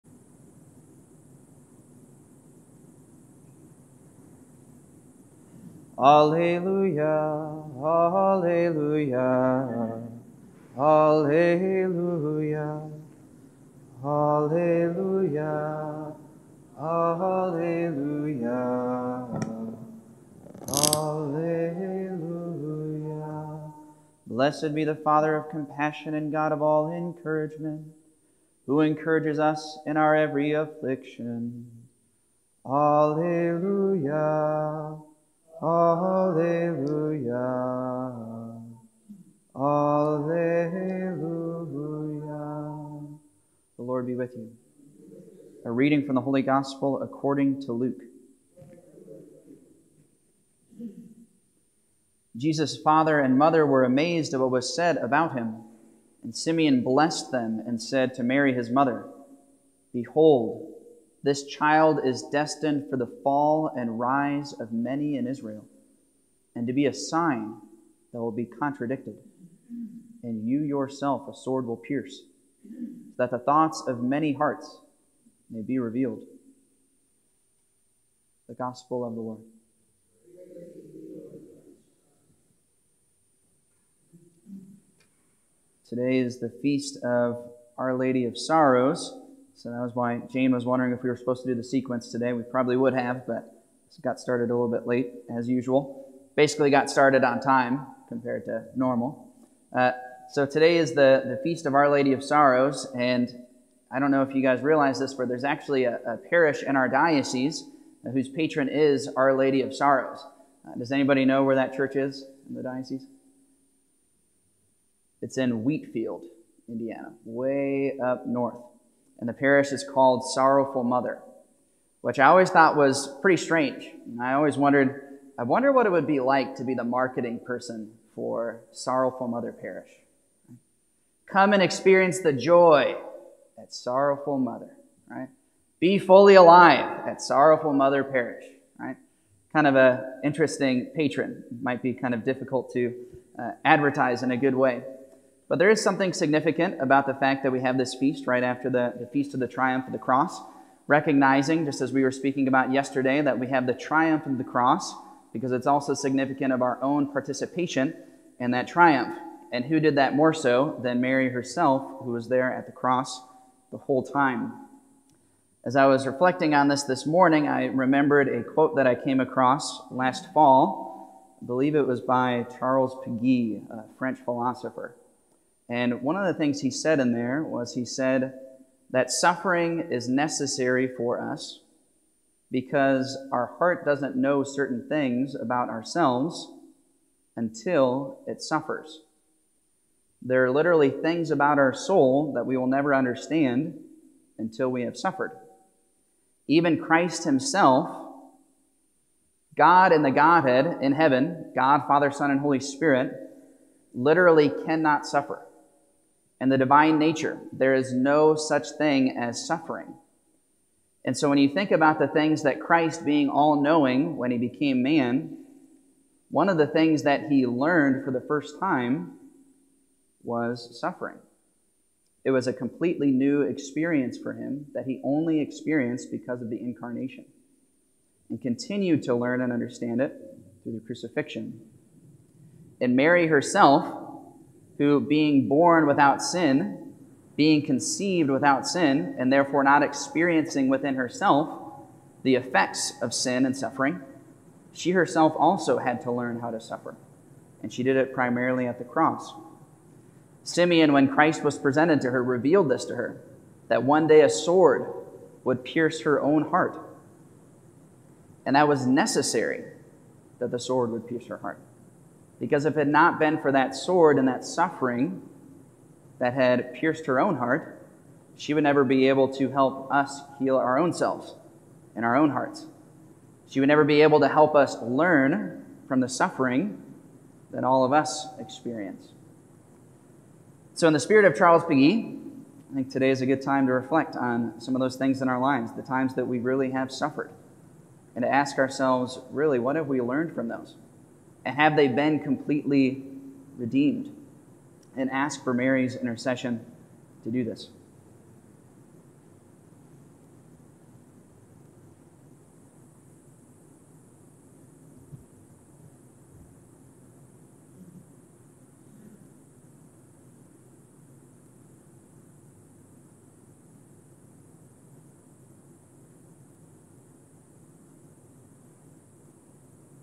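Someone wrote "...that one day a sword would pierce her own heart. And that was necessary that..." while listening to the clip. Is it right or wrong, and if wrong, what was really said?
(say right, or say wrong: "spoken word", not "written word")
right.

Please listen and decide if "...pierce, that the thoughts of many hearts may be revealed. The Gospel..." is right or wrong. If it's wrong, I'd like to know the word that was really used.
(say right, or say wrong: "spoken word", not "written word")
right.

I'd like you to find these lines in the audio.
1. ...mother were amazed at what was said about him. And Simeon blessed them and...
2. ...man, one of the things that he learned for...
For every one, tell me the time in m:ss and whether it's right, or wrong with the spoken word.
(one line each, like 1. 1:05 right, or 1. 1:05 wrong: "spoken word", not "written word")
1. 0:53 right
2. 3:34 right.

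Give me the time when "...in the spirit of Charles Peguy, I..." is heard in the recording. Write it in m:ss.
4:40.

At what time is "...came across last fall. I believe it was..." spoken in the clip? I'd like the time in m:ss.
2:48.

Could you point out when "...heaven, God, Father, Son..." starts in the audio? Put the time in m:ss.
3:20.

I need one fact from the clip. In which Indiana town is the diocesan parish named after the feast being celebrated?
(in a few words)
Wheatfield.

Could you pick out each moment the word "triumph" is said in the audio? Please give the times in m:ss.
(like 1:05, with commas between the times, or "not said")
2:29, 2:33, 2:38.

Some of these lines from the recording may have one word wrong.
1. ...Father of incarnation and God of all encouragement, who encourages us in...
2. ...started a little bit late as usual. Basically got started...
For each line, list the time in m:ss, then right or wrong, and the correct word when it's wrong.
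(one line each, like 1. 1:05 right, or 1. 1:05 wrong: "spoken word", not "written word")
1. 0:24 wrong: "compassion", not "incarnation"
2. 1:34 right.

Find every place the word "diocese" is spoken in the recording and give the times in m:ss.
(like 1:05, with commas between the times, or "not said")
1:46, 1:52.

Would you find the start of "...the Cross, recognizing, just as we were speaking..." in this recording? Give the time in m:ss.
2:29.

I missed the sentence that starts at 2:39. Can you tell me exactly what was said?
And who did that more so than Mary herself, who was there at the cross the whole time?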